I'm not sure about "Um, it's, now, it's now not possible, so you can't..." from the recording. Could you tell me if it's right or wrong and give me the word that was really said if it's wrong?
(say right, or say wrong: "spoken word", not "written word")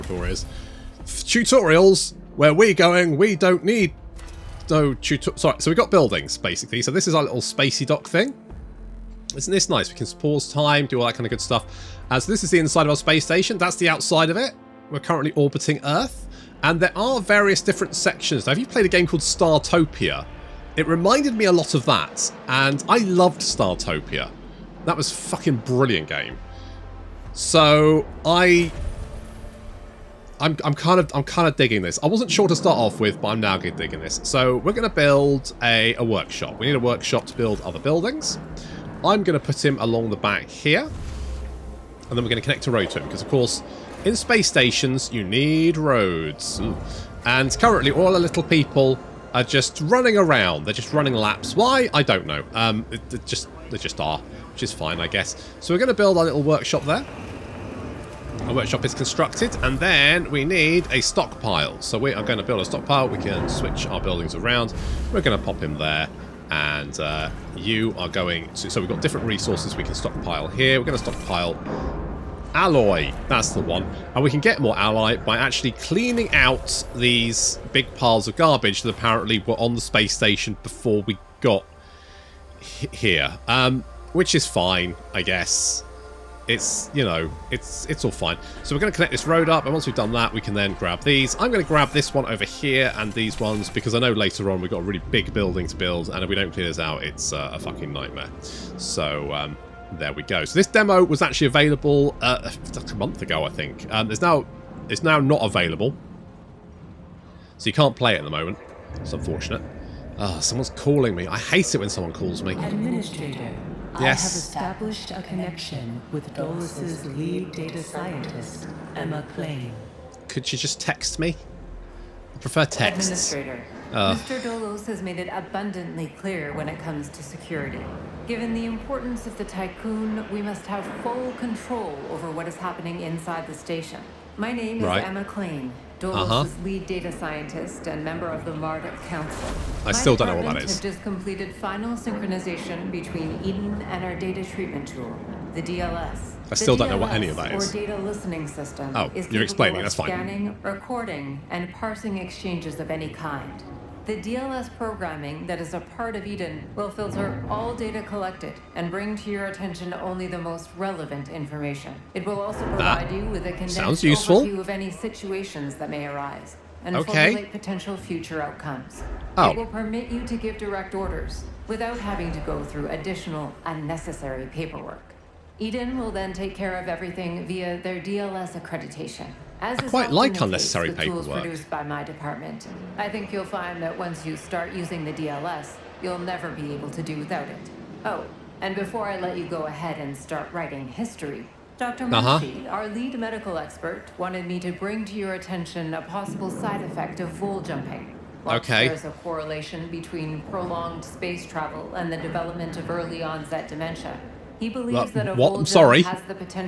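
wrong: "available", not "possible".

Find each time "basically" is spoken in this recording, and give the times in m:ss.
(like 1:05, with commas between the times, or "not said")
0:06.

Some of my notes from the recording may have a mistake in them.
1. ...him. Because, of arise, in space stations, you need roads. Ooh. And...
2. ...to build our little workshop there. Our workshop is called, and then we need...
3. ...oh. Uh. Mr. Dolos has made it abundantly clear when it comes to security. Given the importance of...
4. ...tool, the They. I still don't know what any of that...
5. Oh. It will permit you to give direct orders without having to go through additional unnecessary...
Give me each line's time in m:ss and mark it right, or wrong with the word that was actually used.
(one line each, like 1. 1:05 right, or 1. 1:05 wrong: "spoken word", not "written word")
1. 0:42 wrong: "course", not "arise"
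2. 0:55 wrong: "constructed", not "called"
3. 2:03 right
4. 2:24 wrong: "DLS", not "They"
5. 2:49 right.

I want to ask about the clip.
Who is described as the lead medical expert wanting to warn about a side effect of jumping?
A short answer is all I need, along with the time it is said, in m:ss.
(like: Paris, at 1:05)
Dr. Murphy, at 3:11.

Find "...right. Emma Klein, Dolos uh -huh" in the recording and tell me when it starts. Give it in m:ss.
2:14.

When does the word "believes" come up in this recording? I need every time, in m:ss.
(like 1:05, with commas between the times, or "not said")
3:24.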